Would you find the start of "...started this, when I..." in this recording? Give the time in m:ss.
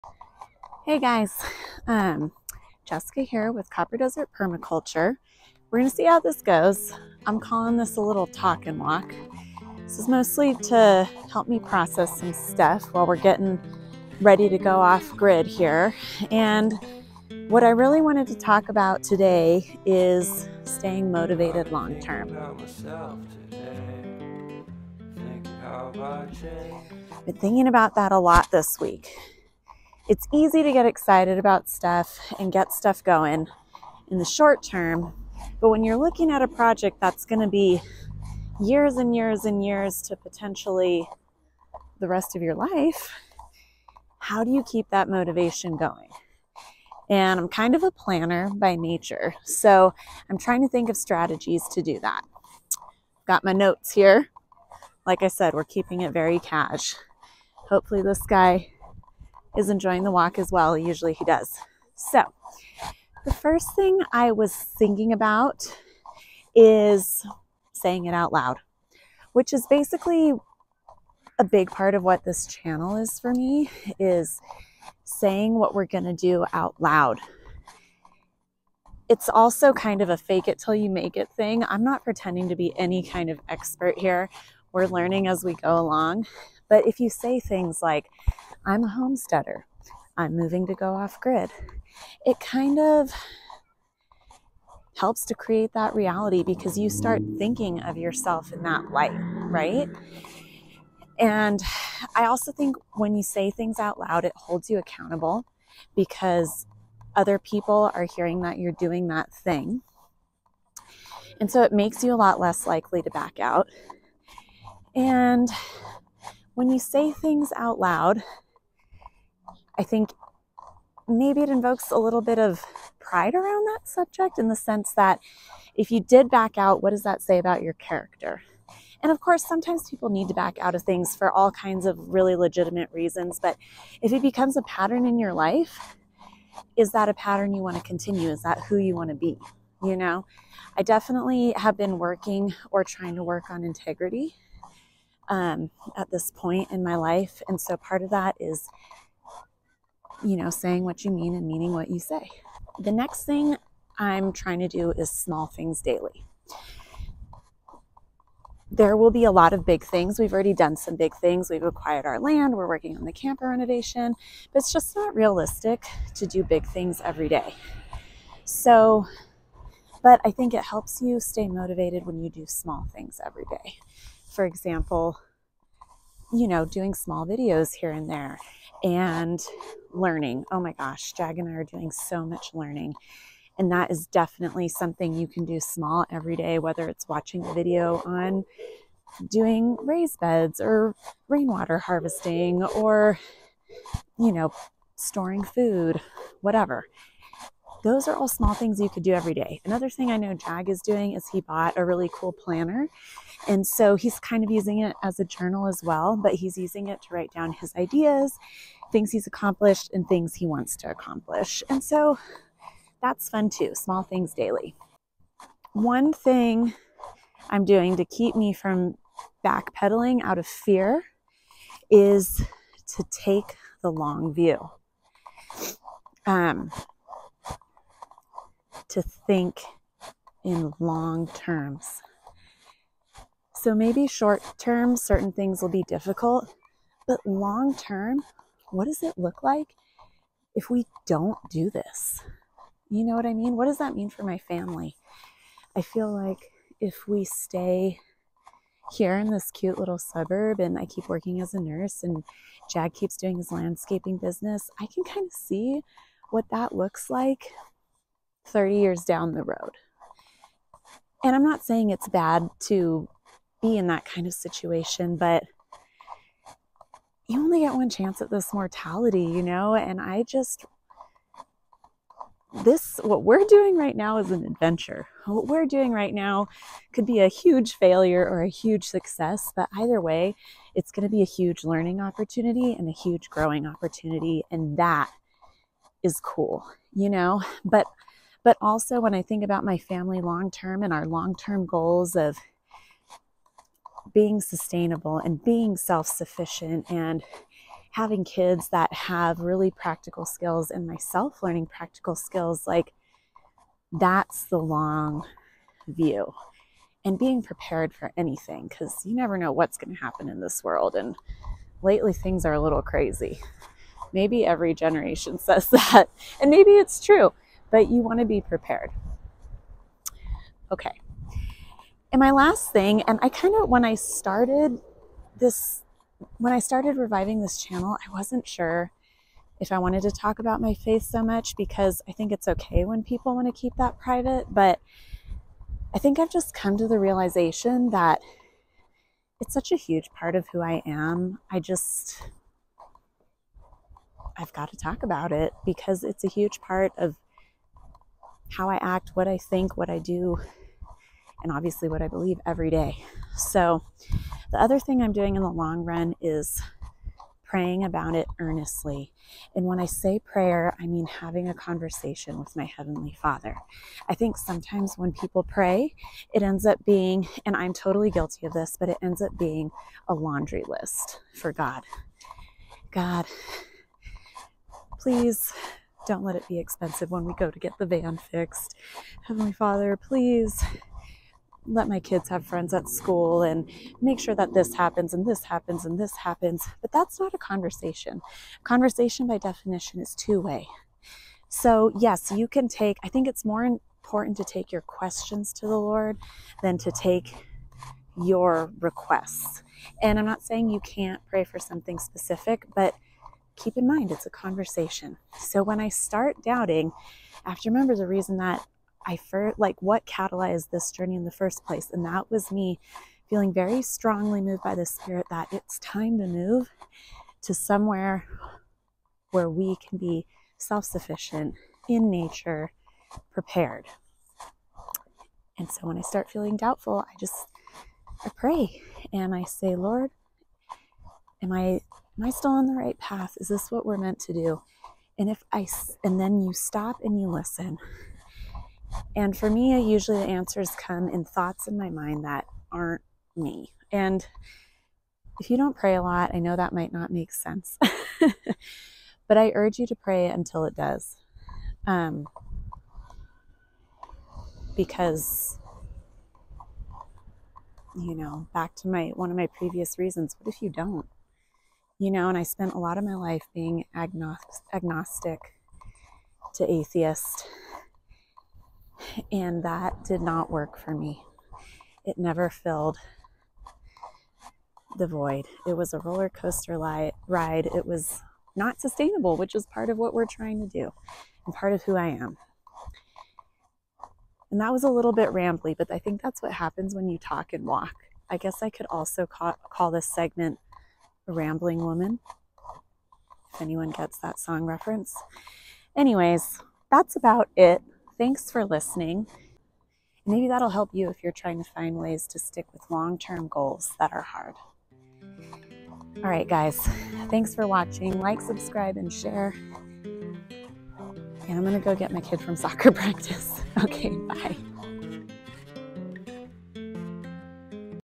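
5:23.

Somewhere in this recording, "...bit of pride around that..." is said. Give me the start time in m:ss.
2:02.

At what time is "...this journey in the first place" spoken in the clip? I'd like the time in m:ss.
6:50.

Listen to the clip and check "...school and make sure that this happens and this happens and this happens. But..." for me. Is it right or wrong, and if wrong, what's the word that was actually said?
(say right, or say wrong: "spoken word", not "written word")
right.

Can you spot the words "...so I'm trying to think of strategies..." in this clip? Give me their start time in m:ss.
0:49.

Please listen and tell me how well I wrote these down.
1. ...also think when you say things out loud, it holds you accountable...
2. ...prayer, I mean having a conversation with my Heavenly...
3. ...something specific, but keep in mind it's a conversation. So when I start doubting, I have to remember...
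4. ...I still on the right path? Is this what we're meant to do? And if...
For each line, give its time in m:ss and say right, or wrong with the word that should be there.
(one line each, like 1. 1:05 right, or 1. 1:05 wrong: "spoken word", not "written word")
1. 1:42 right
2. 6:00 right
3. 6:41 right
4. 7:12 right.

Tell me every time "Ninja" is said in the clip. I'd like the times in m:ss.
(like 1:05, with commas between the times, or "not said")
not said.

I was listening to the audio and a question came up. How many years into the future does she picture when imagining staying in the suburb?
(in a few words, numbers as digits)
30.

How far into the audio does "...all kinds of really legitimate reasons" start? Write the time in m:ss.
2:11.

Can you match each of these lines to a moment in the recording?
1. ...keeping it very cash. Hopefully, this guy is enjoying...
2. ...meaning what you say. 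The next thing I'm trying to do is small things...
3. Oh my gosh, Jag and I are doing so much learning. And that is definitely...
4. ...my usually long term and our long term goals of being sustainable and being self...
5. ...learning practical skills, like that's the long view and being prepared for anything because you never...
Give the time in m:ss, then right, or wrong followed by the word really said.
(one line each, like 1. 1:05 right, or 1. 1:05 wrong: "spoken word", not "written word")
1. 0:55 right
2. 2:31 right
3. 3:00 right
4. 4:49 wrong: "family", not "usually"
5. 5:01 right.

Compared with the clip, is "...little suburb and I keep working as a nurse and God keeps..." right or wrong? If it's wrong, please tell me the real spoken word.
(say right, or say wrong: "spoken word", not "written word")
wrong: "Jag", not "God".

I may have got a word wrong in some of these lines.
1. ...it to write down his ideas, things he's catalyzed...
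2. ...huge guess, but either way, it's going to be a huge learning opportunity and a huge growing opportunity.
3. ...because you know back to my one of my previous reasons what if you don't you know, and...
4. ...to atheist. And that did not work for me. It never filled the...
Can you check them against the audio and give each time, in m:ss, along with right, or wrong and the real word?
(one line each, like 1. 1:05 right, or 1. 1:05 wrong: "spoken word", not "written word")
1. 3:26 wrong: "accomplished", not "catalyzed"
2. 4:38 wrong: "success", not "guess"
3. 7:34 right
4. 7:46 right.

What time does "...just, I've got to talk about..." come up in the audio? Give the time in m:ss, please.
5:41.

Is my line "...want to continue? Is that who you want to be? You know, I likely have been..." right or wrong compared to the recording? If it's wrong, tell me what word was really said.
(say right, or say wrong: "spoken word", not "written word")
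wrong: "definitely", not "likely".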